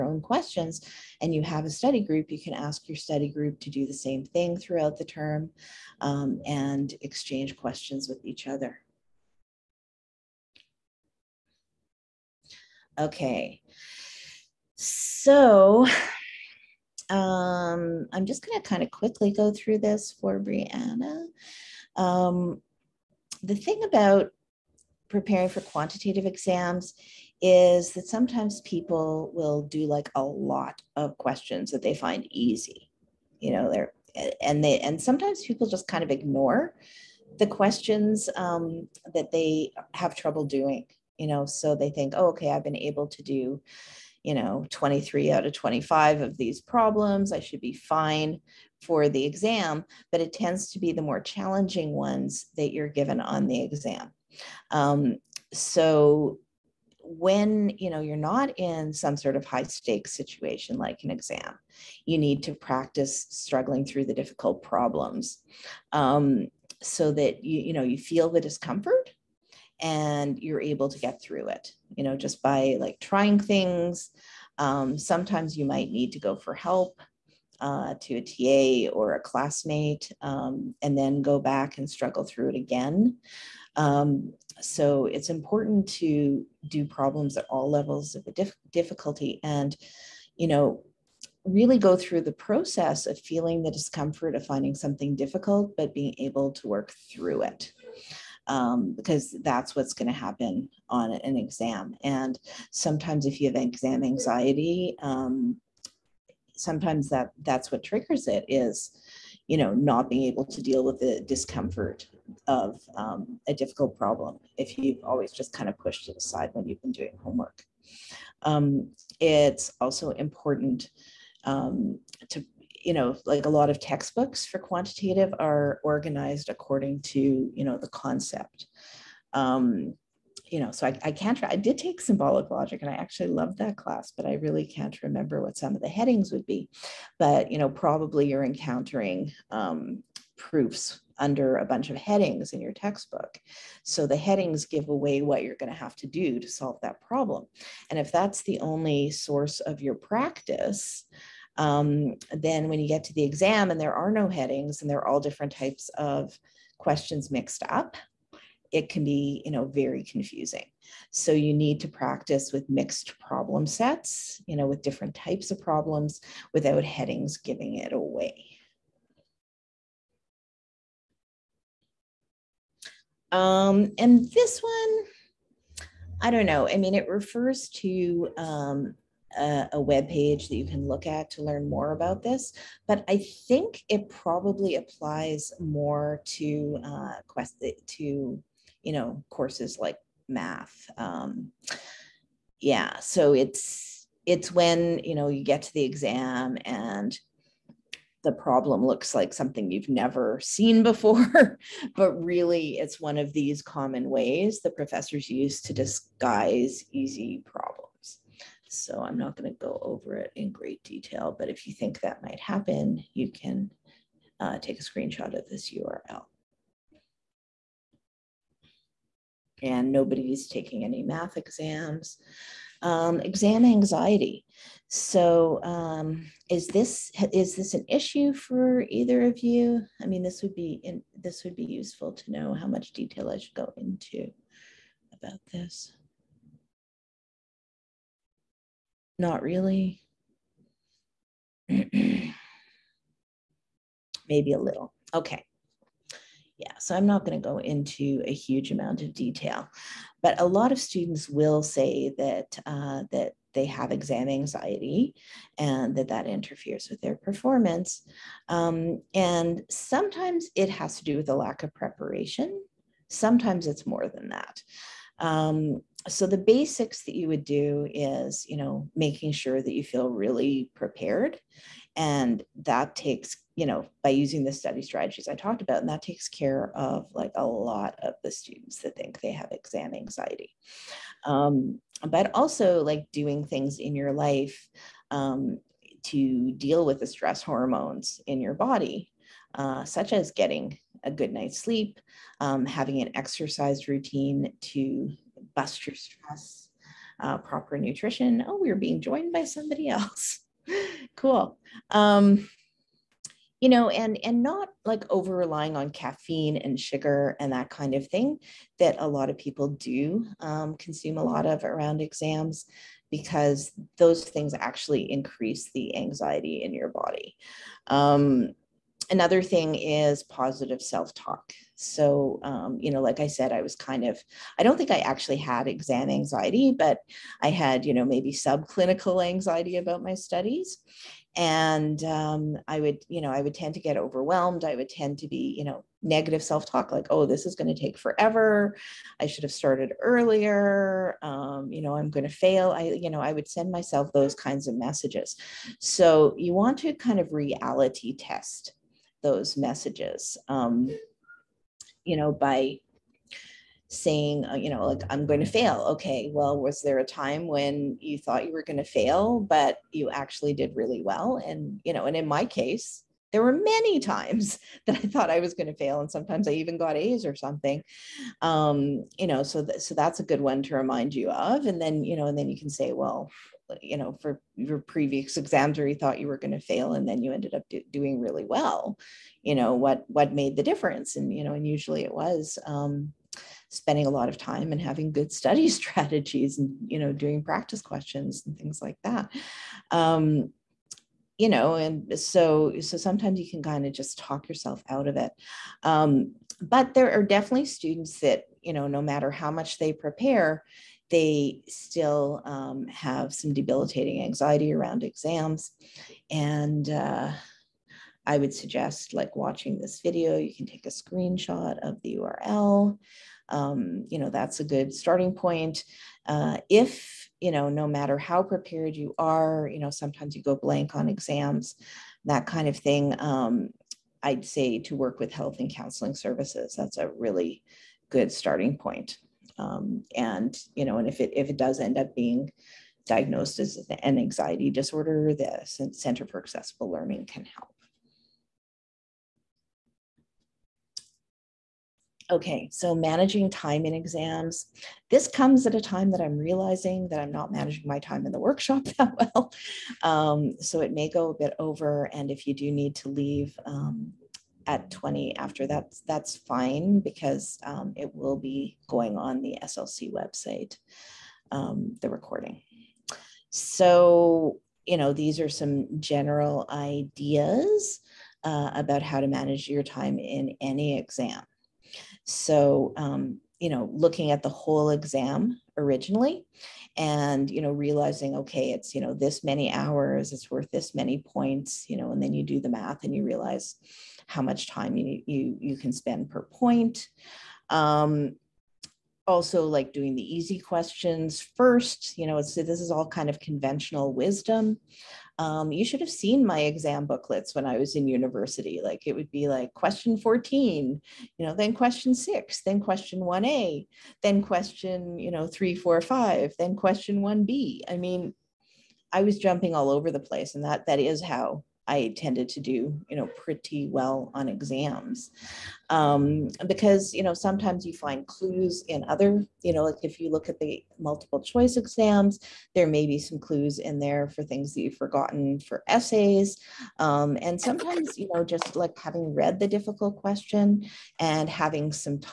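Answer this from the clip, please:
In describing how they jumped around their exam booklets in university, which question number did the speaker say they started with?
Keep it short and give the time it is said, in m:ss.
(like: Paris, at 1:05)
14, at 8:19.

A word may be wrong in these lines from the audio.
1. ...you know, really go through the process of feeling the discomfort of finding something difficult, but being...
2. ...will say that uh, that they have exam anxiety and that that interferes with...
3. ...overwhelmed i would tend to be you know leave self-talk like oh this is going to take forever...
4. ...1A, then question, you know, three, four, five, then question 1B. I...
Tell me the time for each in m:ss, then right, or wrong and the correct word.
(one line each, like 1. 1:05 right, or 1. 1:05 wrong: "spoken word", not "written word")
1. 1:30 right
2. 4:11 right
3. 5:33 wrong: "negative", not "leave"
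4. 8:23 right.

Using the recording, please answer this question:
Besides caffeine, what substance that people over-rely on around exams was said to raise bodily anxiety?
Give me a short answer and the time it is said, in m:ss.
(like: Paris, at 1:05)
Sugar, at 5:06.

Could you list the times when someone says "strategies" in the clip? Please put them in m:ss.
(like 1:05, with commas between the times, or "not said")
4:34, 6:25.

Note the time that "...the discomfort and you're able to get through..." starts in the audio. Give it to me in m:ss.
1:08.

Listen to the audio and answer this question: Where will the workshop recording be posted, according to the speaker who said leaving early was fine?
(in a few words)
SLC website.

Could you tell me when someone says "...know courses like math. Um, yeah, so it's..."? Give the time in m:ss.
3:08.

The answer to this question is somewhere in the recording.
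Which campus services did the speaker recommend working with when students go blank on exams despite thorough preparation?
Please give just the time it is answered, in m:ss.
7:05.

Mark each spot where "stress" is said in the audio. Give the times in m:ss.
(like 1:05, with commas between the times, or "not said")
4:47, 4:55.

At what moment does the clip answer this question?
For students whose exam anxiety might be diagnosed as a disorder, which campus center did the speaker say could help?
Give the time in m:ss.
7:15.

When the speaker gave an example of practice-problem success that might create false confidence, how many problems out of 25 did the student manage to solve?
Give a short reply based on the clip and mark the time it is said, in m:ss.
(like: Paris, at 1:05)
23, at 0:44.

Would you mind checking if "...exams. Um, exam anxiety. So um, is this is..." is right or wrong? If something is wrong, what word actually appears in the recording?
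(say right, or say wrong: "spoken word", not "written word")
right.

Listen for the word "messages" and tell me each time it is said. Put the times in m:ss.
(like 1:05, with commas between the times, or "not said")
5:44, 5:49.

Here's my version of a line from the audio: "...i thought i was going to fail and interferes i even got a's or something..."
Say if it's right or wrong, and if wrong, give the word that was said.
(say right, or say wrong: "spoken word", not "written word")
wrong: "sometimes", not "interferes".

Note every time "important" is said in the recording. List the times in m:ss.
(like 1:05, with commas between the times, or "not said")
1:25, 2:00.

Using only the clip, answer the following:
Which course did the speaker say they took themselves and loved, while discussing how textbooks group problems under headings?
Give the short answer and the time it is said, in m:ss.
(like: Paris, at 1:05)
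Symbolic logic, at 2:11.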